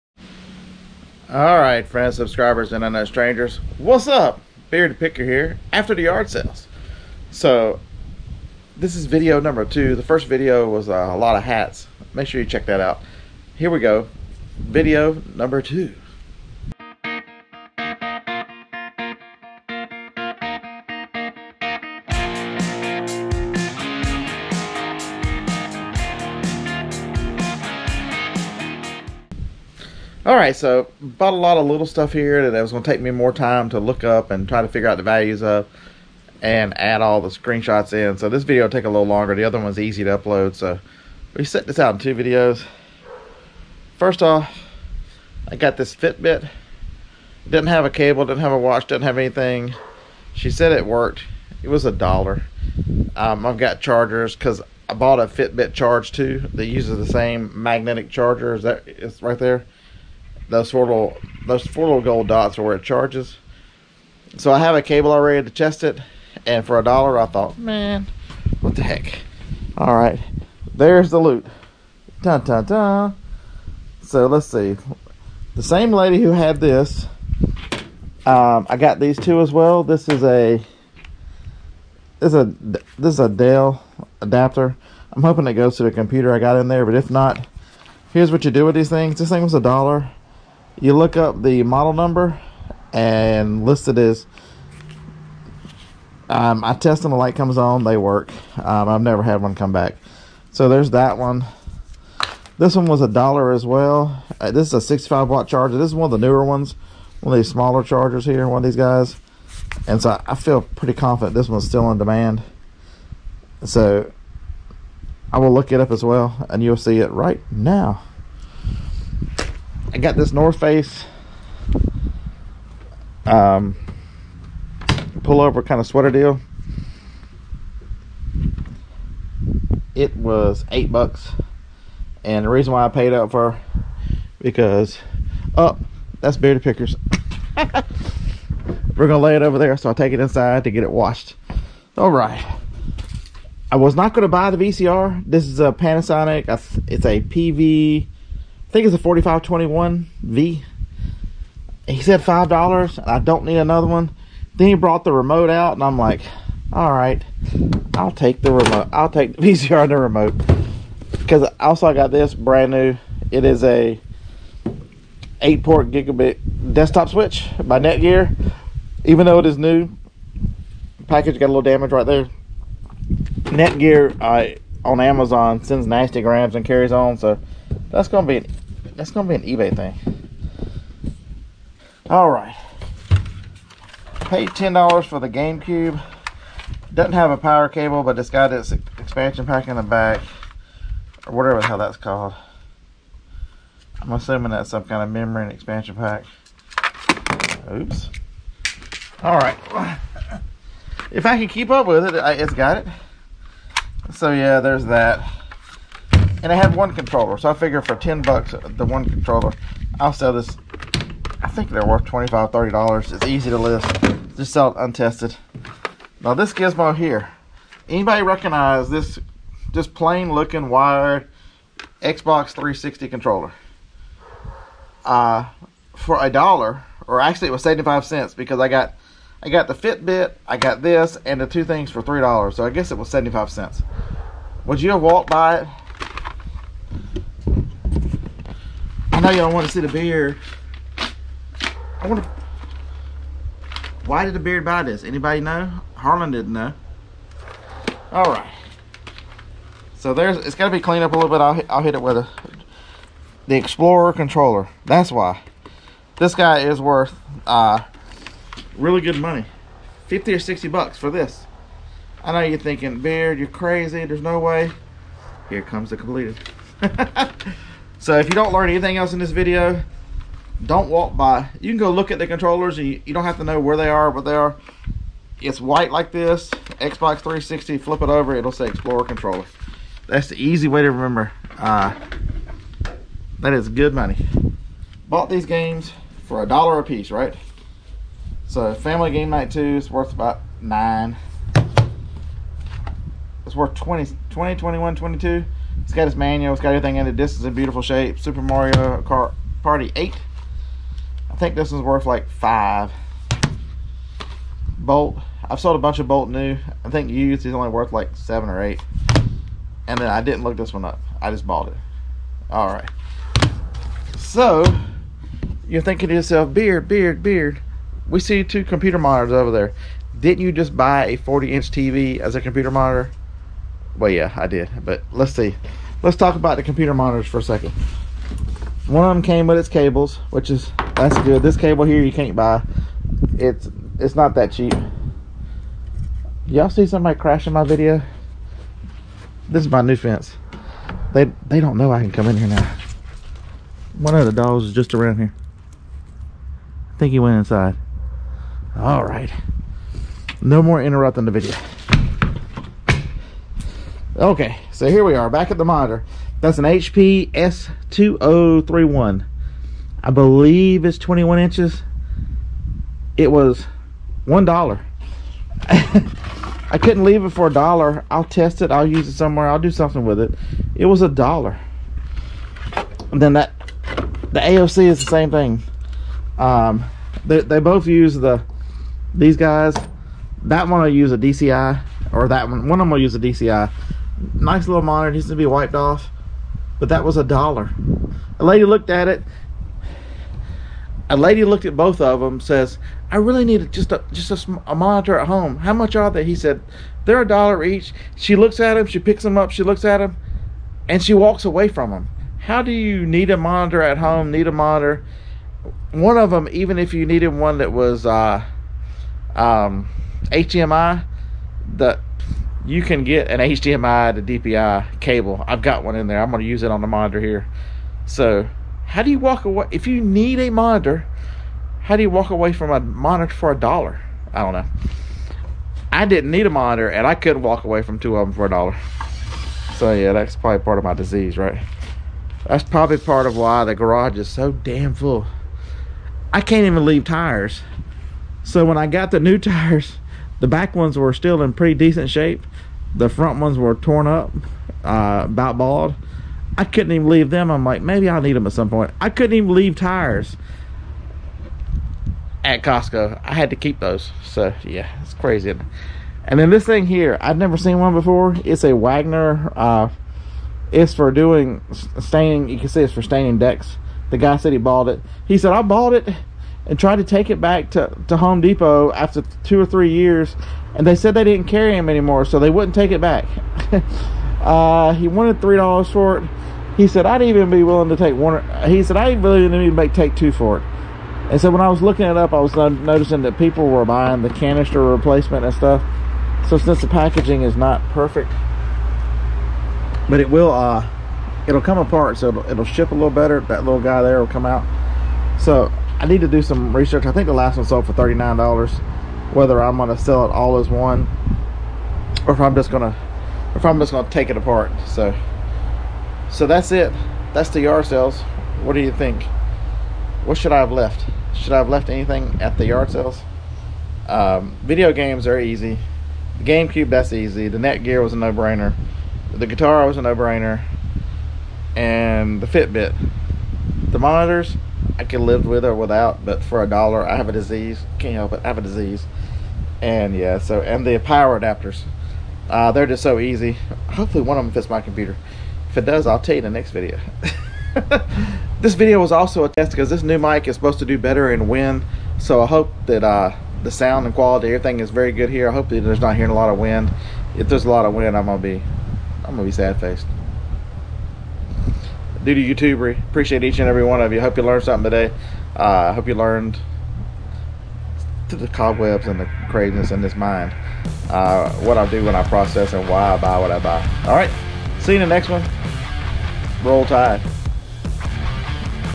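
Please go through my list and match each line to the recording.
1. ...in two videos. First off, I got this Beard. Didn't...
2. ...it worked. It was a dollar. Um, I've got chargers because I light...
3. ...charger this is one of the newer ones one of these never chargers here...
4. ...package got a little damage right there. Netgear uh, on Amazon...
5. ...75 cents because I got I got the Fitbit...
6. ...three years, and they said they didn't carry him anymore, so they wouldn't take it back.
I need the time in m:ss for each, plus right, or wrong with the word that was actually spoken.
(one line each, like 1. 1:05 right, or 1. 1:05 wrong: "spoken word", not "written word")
1. 0:41 wrong: "Fitbit", not "Beard"
2. 0:50 wrong: "bought", not "light"
3. 1:45 wrong: "smaller", not "never"
4. 2:51 right
5. 3:47 right
6. 7:49 right.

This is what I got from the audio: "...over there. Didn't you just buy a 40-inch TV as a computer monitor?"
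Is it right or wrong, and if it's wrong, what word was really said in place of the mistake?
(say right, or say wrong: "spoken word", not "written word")
right.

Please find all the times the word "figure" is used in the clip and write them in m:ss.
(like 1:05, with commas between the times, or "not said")
0:34, 3:27.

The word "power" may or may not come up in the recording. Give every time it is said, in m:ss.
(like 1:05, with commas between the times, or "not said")
3:07, 8:50.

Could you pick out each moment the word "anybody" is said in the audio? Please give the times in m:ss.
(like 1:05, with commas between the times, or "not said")
3:37, 4:05.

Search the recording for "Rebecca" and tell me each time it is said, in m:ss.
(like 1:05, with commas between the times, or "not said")
not said.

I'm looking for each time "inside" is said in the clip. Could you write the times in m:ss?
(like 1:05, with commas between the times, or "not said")
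2:20, 5:47.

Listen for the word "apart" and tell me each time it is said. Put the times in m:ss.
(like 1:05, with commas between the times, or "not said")
8:11, 8:24.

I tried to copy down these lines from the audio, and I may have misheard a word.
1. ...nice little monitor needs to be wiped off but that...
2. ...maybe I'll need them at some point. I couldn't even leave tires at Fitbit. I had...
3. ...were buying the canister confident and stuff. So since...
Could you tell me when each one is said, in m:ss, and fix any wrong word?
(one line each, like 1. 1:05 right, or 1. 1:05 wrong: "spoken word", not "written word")
1. 6:24 right
2. 7:27 wrong: "Costco", not "Fitbit"
3. 8:03 wrong: "replacement", not "confident".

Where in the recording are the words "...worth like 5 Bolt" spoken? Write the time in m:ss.
5:01.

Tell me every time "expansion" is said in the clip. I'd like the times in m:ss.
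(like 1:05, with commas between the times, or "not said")
3:08, 3:15.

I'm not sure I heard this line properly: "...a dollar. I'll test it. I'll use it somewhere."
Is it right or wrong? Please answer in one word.
right.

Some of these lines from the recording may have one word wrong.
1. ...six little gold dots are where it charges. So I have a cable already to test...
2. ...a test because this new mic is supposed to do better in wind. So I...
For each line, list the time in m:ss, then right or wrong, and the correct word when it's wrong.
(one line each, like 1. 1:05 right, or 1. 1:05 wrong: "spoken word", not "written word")
1. 1:01 wrong: "four", not "six"
2. 8:59 right.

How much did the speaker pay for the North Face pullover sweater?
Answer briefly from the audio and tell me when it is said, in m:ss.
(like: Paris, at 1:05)
8 bucks, at 2:10.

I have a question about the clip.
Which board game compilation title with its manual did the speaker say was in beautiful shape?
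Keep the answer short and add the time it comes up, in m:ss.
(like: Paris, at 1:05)
Family Game Night 2, at 4:48.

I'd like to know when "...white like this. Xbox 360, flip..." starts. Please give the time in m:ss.
4:35.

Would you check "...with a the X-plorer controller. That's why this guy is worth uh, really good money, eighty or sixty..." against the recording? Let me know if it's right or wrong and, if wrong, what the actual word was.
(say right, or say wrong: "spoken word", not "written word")
wrong: "fifty", not "eighty".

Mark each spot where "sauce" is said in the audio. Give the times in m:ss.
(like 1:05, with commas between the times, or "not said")
not said.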